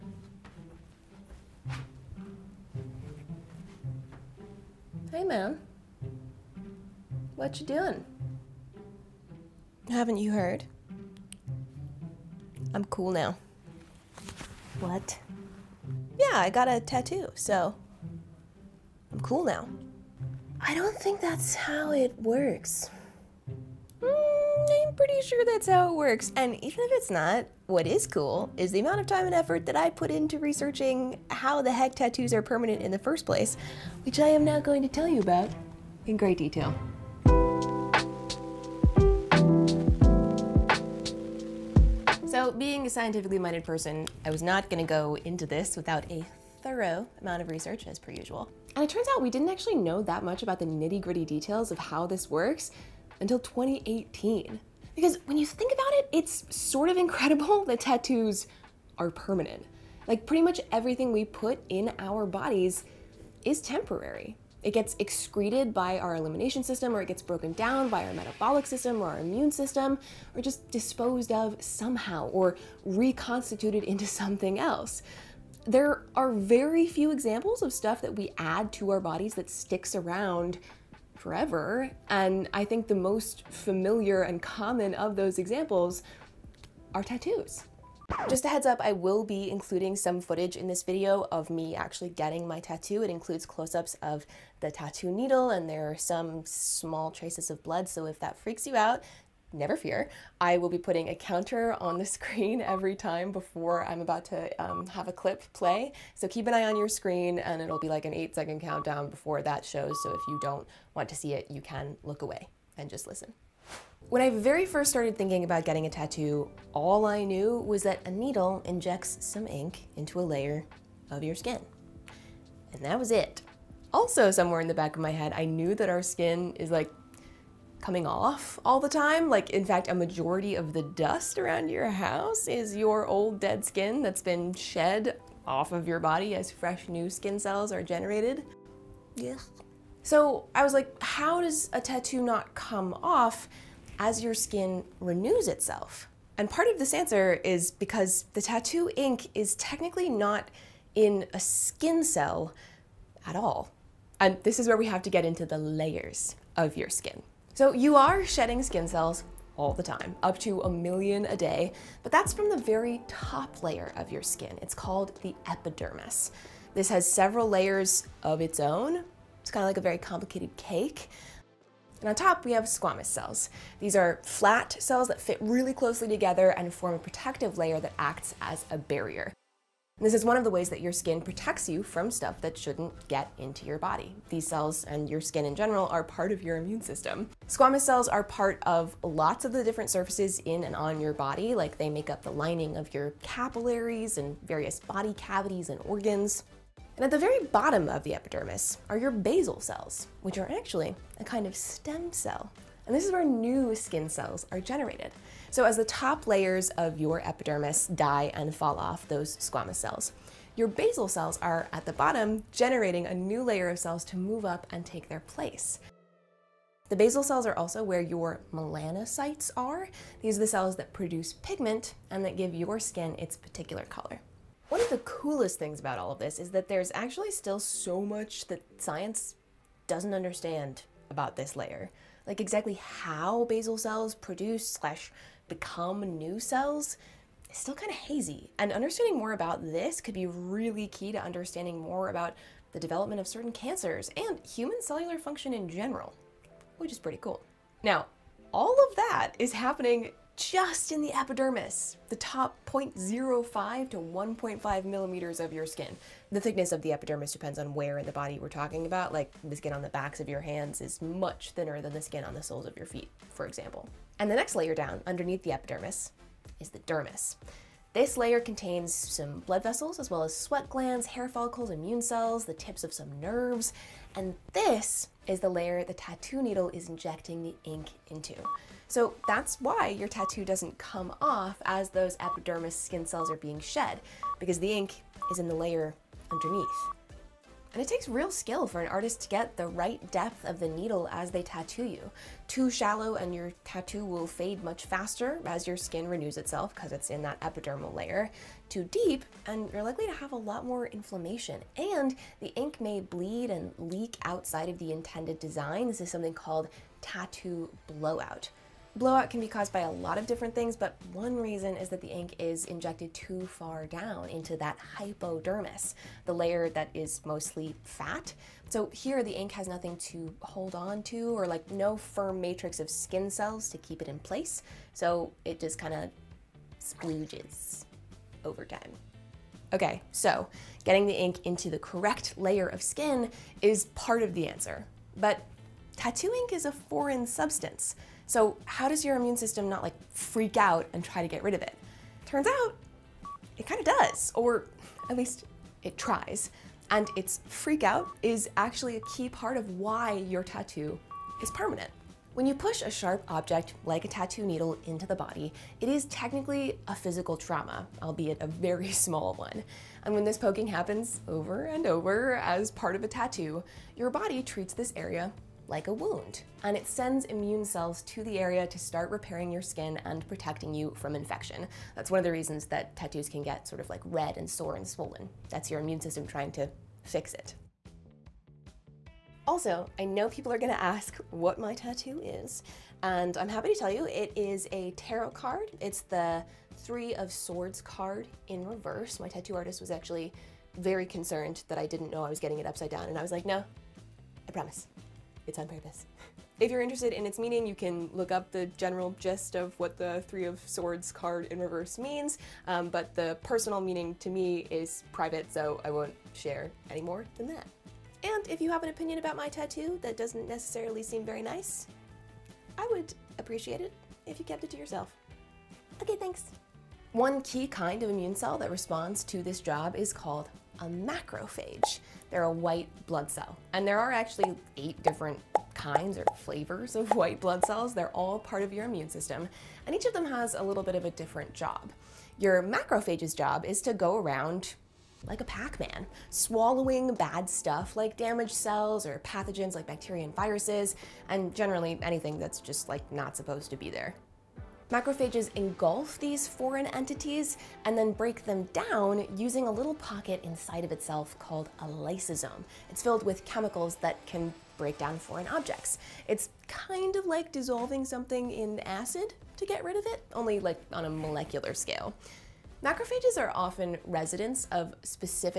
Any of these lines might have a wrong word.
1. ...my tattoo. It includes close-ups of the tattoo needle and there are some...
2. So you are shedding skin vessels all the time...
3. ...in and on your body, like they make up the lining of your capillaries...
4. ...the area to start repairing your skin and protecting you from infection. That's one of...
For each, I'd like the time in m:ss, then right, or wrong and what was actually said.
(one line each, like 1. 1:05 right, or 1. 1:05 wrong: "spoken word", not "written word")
1. 1:32 right
2. 2:37 wrong: "cells", not "vessels"
3. 3:10 right
4. 6:08 right.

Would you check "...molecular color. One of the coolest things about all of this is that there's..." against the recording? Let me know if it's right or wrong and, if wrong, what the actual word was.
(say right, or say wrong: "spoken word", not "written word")
wrong: "particular", not "molecular".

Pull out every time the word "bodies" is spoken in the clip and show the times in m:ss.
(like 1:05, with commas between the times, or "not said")
1:02, 1:19.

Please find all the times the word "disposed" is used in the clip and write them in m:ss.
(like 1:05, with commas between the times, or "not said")
1:10.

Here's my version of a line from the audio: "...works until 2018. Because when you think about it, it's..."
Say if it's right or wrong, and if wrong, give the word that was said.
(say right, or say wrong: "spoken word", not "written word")
right.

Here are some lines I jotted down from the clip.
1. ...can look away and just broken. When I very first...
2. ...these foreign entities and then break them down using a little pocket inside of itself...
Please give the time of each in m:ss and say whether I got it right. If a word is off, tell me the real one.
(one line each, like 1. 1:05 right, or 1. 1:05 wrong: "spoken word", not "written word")
1. 1:51 wrong: "listen", not "broken"
2. 7:26 right.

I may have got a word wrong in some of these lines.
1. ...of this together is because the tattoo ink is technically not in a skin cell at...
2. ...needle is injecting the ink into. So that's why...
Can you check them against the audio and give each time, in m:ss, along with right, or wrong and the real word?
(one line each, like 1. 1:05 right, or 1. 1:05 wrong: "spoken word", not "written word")
1. 2:26 wrong: "answer", not "together"
2. 4:36 right.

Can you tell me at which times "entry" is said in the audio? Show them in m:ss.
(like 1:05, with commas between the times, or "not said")
not said.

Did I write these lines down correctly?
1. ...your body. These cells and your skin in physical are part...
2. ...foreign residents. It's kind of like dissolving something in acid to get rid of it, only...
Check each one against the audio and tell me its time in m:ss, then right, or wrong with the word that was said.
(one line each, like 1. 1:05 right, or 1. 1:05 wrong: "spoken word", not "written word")
1. 3:03 wrong: "general", not "physical"
2. 7:35 wrong: "objects", not "residents".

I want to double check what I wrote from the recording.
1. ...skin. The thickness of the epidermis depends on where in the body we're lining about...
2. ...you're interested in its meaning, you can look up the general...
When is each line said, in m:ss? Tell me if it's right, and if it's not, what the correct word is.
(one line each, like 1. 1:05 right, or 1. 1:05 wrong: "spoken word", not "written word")
1. 4:15 wrong: "talking", not "lining"
2. 6:36 right.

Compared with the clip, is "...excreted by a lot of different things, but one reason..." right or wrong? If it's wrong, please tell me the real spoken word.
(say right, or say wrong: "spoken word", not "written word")
wrong: "caused", not "excreted".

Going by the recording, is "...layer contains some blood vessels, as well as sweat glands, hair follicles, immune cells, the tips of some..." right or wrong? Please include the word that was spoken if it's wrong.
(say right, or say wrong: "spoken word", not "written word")
right.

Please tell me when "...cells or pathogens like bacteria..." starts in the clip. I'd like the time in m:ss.
7:18.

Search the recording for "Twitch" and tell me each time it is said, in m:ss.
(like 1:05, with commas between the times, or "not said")
not said.